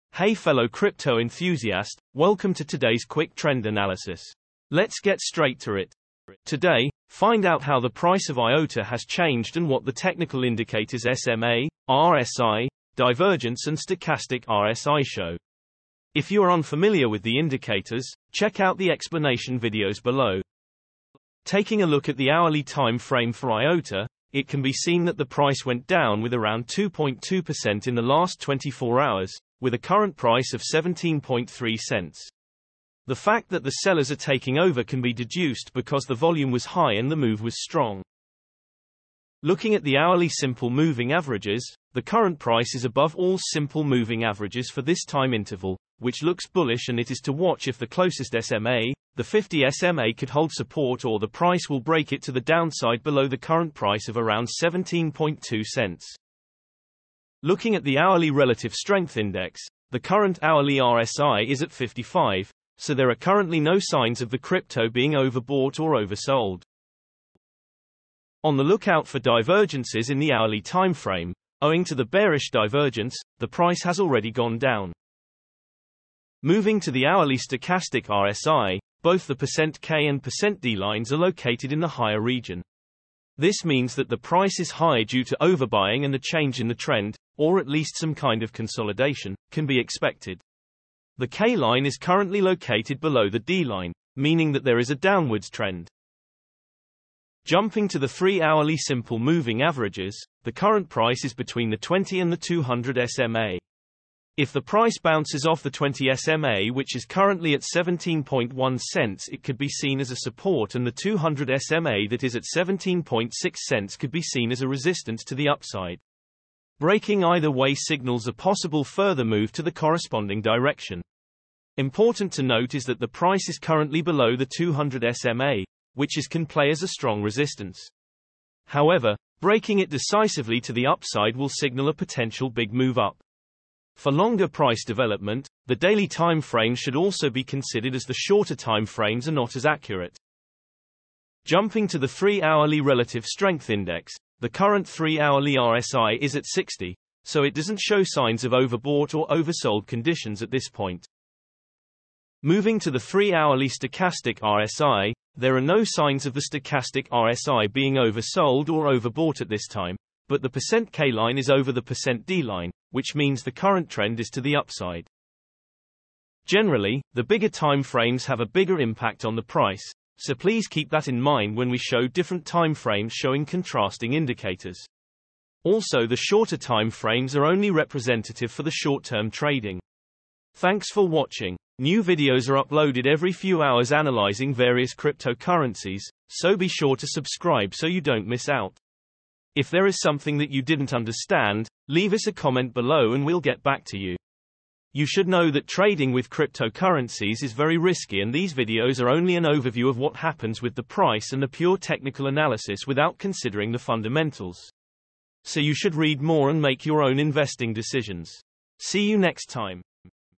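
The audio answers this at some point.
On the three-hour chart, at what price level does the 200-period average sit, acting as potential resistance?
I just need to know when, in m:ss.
1:52.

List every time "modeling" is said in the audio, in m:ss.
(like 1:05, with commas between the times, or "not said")
not said.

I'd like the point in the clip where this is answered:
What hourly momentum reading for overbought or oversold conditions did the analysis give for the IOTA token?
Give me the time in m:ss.
1:01.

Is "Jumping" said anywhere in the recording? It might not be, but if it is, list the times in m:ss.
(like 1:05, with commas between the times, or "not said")
1:37, 2:21.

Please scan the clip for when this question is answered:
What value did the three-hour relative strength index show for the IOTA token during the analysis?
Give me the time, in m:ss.
2:26.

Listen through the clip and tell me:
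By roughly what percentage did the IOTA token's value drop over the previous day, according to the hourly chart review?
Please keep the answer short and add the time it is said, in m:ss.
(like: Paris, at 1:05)
2.2%, at 0:26.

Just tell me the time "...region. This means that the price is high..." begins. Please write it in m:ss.
1:22.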